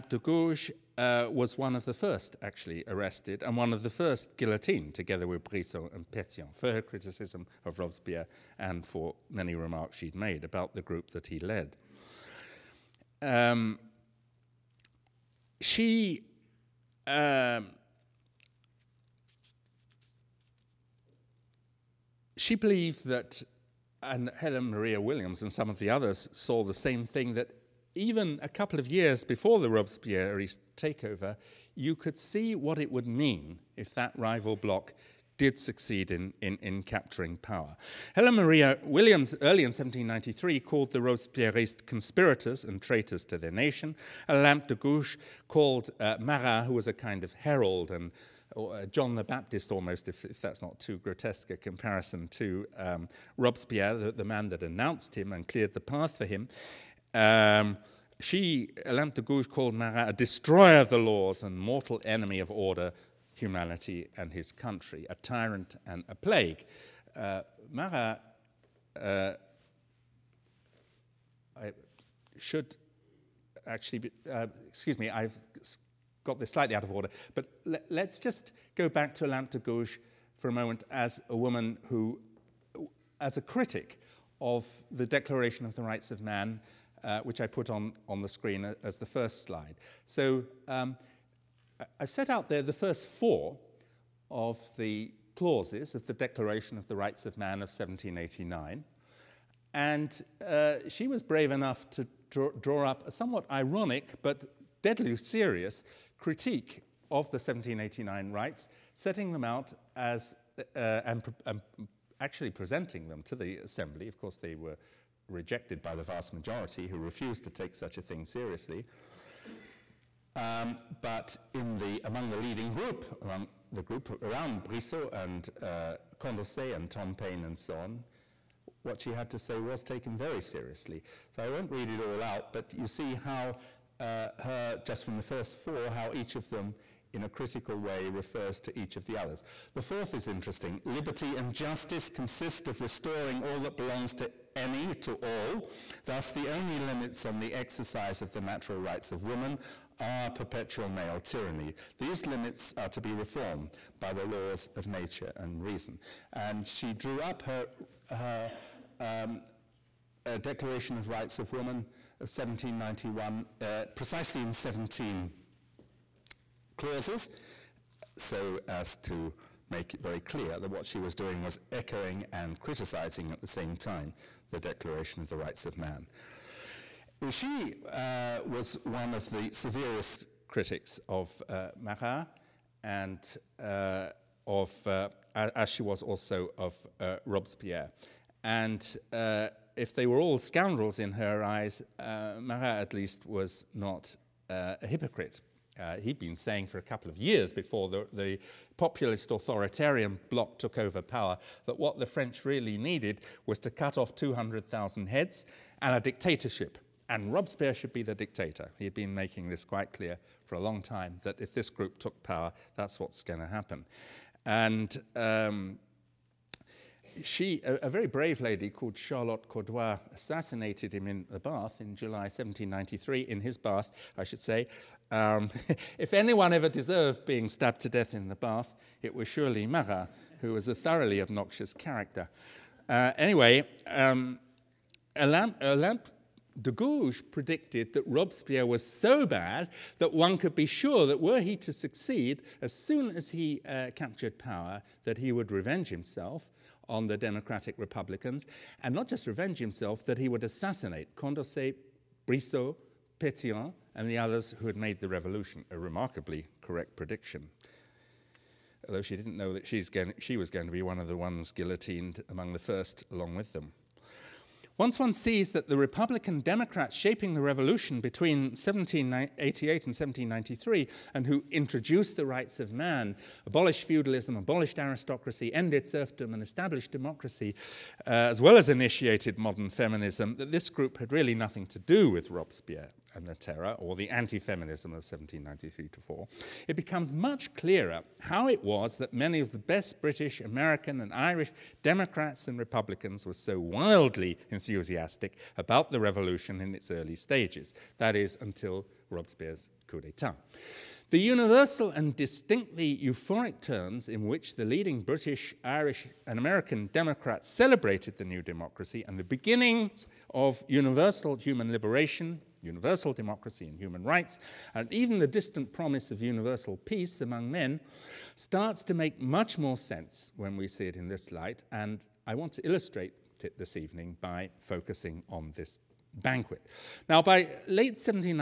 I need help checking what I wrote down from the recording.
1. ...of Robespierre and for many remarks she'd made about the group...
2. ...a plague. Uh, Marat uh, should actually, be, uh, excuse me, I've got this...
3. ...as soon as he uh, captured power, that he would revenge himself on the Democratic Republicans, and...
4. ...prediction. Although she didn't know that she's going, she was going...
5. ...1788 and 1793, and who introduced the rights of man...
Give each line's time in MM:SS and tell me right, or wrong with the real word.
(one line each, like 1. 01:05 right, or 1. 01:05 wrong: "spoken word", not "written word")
1. 00:07 right
2. 01:06 right
3. 04:02 right
4. 04:16 right
5. 04:28 right.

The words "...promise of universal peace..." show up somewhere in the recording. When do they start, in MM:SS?
05:15.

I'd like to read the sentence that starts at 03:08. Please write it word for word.
And uh, if they were all scoundrels in her eyes, uh, Marat at least was not uh, a hypocrite.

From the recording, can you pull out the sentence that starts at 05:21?
And I want to illustrate it this evening by focusing on this banquet.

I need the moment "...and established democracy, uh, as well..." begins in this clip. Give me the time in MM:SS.
04:36.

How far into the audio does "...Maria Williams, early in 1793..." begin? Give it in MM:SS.
00:38.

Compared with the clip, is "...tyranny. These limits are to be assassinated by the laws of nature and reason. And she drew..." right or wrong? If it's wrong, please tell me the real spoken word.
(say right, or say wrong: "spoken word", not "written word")
wrong: "reformed", not "assassinated".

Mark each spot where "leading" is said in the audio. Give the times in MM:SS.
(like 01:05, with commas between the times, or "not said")
02:02, 05:04.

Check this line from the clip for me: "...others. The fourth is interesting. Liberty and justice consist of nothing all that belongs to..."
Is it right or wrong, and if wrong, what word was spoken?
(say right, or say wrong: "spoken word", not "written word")
wrong: "restoring", not "nothing".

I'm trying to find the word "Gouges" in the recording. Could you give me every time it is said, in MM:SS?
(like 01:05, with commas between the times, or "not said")
00:00, 00:44, 00:59, 01:19, 03:56.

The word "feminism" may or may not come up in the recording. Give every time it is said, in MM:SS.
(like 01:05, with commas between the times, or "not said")
04:39, 04:44.